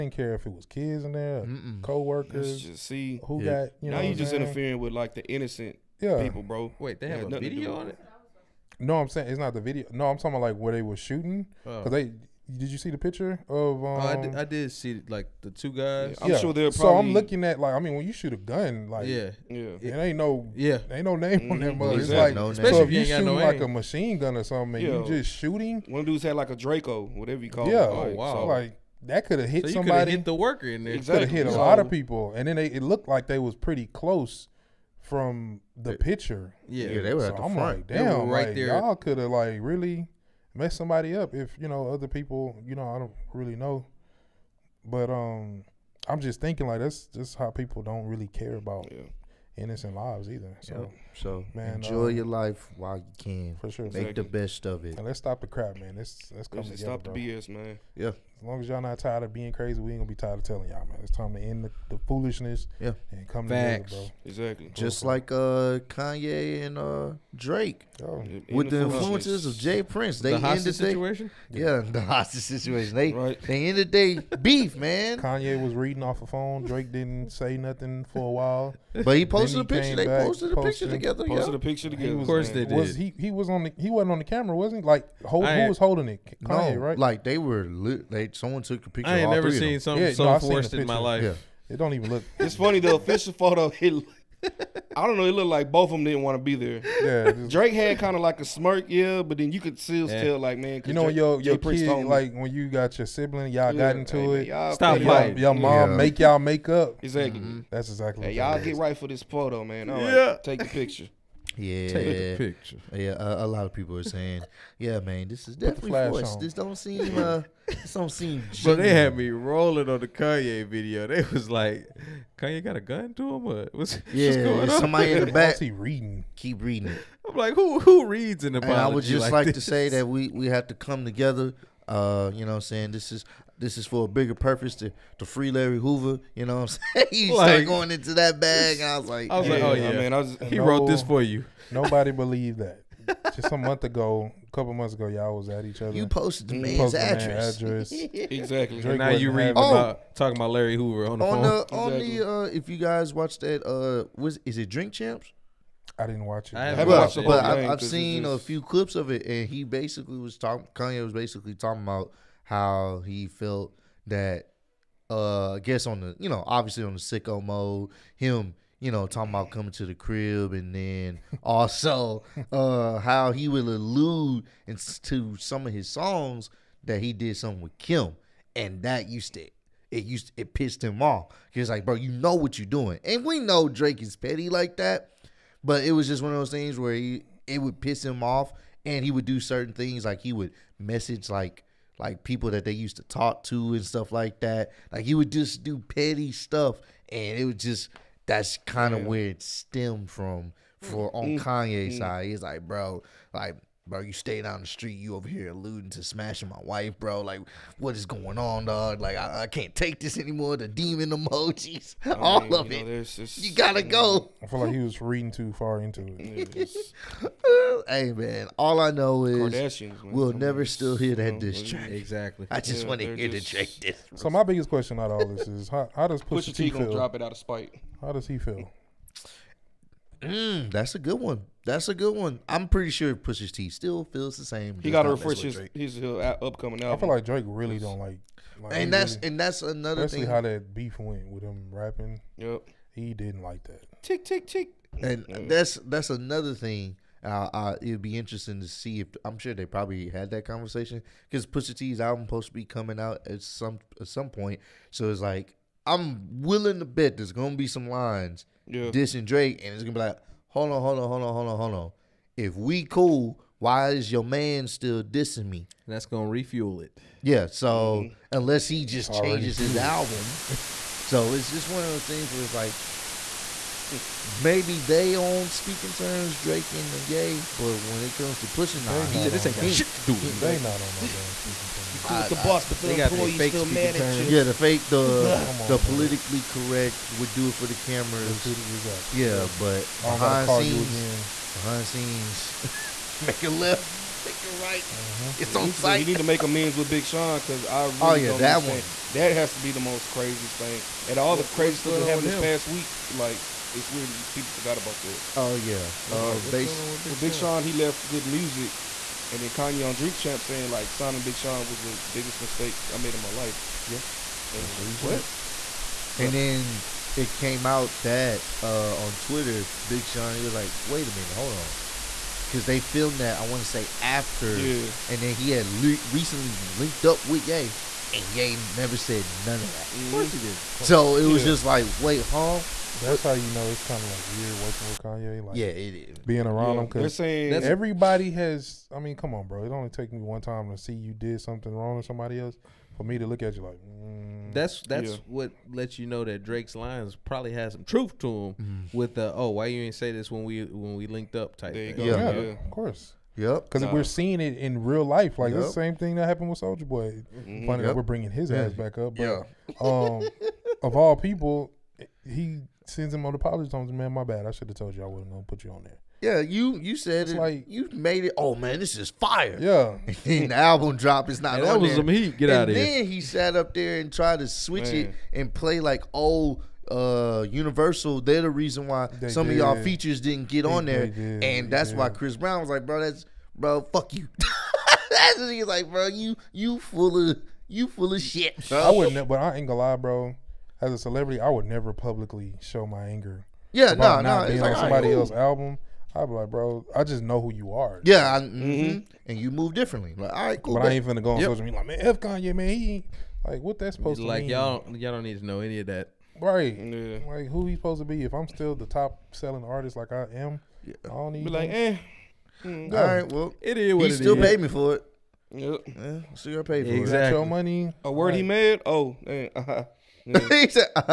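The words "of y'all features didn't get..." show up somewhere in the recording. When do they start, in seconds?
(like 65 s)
379 s.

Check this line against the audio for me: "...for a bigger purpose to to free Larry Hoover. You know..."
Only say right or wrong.
right.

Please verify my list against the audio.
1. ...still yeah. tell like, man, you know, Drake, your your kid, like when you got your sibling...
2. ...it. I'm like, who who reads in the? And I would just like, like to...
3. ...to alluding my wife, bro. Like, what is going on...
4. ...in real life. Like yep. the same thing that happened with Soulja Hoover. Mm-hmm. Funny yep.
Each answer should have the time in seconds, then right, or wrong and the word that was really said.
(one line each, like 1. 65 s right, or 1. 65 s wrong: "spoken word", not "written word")
1. 99 s right
2. 126 s right
3. 205 s wrong: "smashing", not "alluding"
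4. 354 s wrong: "Boy", not "Hoover".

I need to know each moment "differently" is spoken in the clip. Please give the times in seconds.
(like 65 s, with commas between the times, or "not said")
399 s.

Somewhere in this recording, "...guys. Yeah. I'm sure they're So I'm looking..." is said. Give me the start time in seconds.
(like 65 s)
15 s.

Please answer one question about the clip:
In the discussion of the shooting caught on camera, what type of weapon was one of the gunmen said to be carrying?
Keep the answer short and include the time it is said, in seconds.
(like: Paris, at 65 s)
Draco, at 26 s.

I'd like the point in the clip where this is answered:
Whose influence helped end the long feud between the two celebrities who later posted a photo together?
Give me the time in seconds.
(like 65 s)
69 s.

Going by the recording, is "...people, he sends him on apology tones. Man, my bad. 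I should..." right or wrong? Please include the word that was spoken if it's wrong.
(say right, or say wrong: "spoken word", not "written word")
right.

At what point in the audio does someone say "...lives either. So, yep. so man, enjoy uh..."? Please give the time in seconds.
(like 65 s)
49 s.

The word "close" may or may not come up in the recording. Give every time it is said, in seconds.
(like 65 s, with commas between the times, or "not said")
33 s.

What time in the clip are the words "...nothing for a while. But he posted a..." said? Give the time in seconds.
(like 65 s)
77 s.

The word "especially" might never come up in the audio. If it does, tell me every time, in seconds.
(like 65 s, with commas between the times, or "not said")
22 s, 240 s.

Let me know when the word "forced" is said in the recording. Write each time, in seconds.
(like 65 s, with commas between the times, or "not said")
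90 s, 115 s.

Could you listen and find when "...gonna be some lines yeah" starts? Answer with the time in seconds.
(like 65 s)
257 s.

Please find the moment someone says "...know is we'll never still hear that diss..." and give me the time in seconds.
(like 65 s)
218 s.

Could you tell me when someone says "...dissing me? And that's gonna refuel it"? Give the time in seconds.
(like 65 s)
265 s.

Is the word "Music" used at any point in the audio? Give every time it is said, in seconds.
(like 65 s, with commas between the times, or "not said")
308 s.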